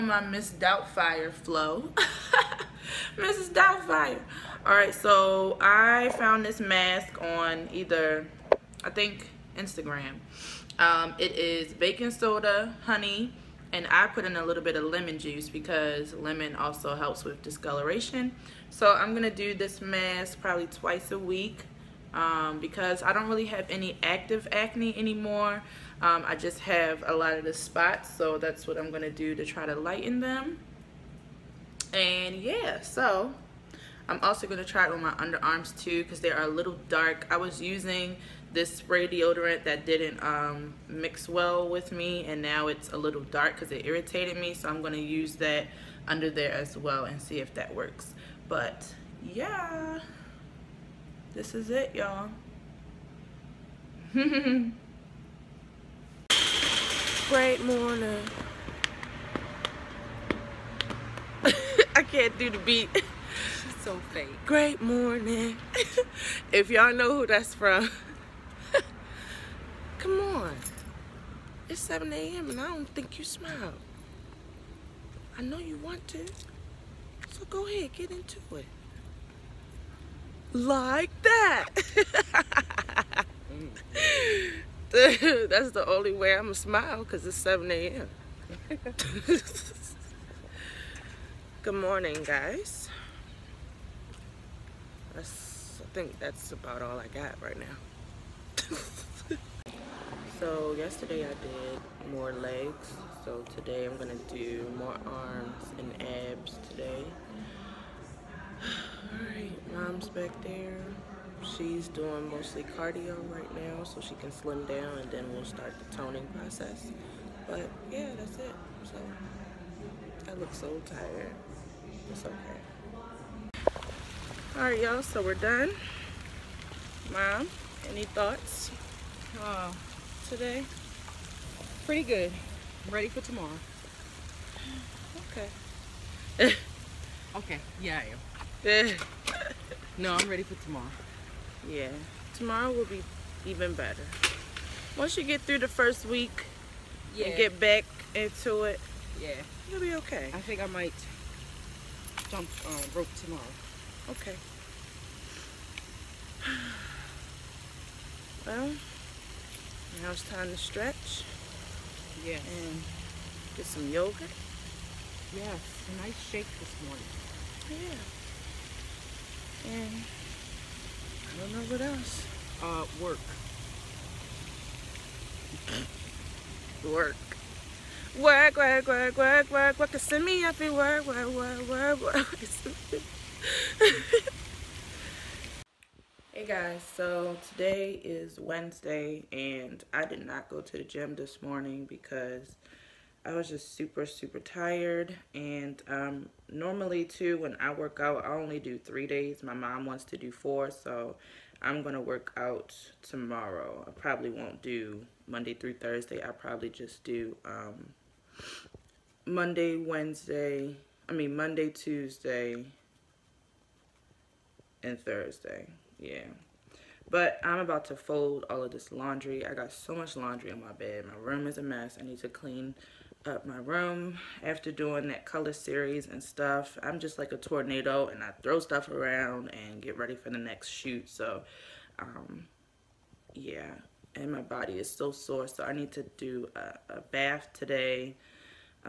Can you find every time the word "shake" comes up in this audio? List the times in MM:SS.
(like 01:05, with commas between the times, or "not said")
02:46.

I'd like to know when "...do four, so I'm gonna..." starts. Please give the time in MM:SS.
03:20.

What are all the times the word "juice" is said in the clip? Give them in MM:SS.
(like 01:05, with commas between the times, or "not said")
00:15.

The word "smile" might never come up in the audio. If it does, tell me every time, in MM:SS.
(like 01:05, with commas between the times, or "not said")
01:13, 01:26.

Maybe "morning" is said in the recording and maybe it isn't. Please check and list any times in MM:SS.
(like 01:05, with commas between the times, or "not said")
00:57, 01:04, 01:31, 02:46, 03:11.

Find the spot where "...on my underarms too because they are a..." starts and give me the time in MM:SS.
00:34.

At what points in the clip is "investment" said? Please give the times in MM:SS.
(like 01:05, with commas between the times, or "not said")
not said.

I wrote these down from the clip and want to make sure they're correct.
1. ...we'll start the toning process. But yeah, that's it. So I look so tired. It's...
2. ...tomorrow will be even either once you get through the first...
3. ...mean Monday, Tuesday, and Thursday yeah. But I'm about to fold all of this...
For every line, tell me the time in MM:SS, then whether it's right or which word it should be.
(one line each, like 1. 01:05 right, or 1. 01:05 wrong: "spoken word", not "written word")
1. 01:55 right
2. 02:22 wrong: "better", not "either"
3. 03:31 right.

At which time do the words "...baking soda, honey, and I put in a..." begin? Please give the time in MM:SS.
00:11.